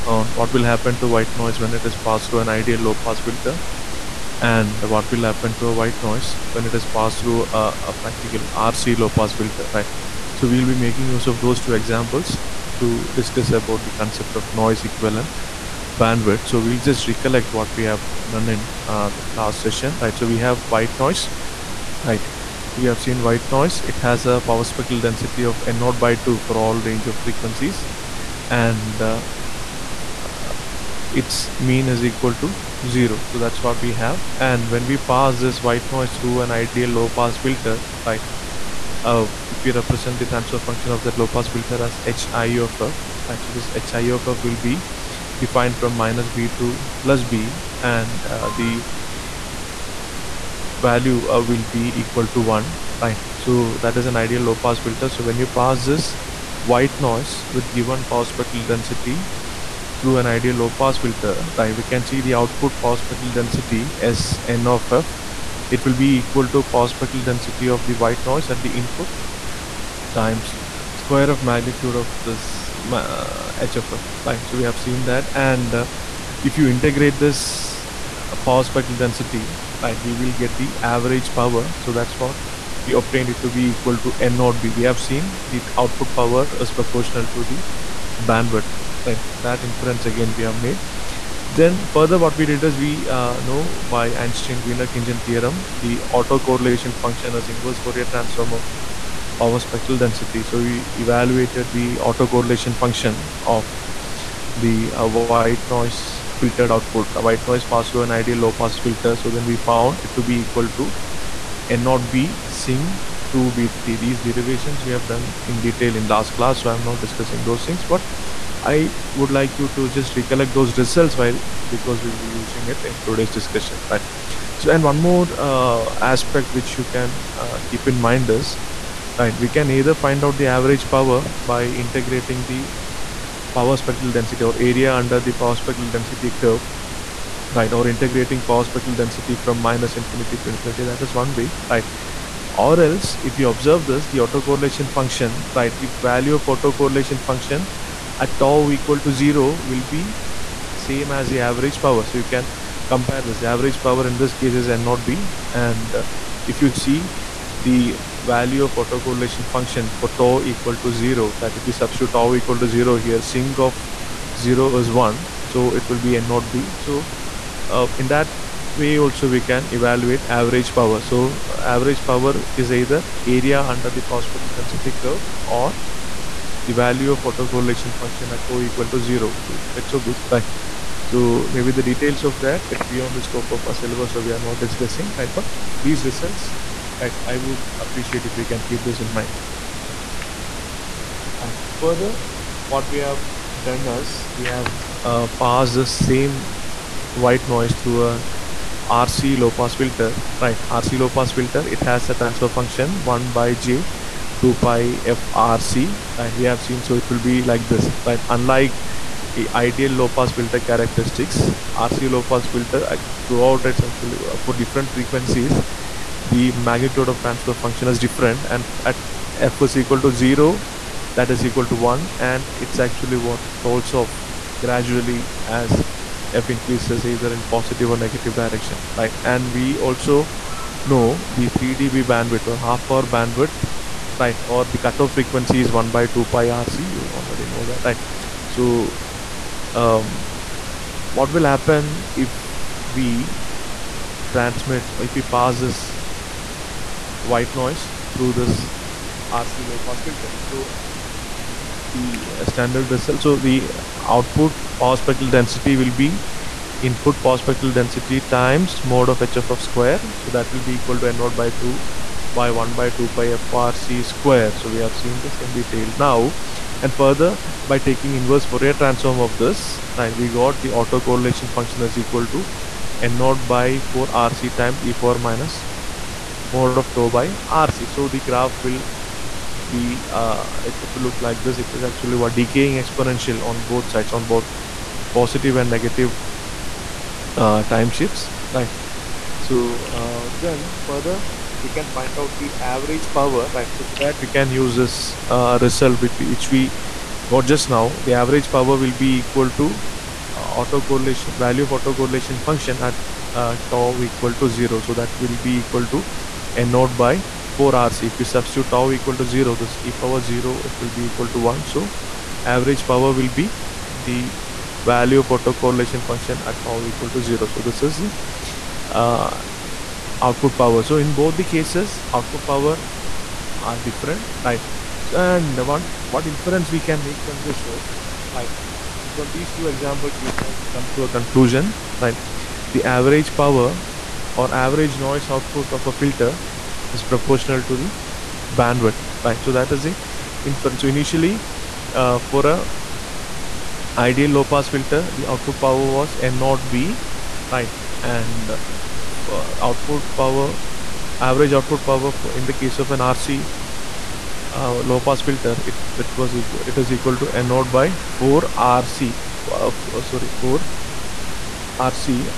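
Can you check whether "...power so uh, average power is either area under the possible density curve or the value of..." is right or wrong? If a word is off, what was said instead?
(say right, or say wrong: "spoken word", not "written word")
right.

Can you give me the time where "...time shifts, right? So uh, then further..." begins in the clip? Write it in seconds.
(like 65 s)
287 s.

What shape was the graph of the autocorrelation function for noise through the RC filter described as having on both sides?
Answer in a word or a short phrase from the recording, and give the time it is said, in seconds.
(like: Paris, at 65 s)
Decaying exponential, at 282 s.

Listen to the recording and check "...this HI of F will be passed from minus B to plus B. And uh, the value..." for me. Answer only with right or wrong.
wrong.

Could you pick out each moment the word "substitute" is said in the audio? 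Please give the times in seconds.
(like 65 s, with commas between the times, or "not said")
161 s, 308 s.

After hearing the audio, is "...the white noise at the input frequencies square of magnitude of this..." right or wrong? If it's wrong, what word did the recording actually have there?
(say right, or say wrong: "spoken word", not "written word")
wrong: "times", not "frequencies".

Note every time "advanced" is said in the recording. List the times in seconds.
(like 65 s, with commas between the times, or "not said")
not said.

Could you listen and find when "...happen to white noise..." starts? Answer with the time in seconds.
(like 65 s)
0 s.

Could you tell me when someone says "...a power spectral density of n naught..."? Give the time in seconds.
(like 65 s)
24 s.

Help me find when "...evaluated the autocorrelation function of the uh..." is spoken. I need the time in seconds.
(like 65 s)
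100 s.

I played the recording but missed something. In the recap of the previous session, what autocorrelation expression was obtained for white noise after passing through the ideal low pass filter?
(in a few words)
N0 B sinc 2BT.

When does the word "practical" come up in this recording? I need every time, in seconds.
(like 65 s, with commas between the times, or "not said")
7 s.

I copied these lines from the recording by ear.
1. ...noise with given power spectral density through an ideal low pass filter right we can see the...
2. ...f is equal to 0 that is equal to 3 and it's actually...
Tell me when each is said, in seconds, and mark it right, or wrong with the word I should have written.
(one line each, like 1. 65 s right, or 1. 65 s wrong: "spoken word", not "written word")
1. 57 s right
2. 219 s wrong: "1", not "3".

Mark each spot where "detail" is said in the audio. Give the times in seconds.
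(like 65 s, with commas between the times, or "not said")
115 s, 181 s, 265 s.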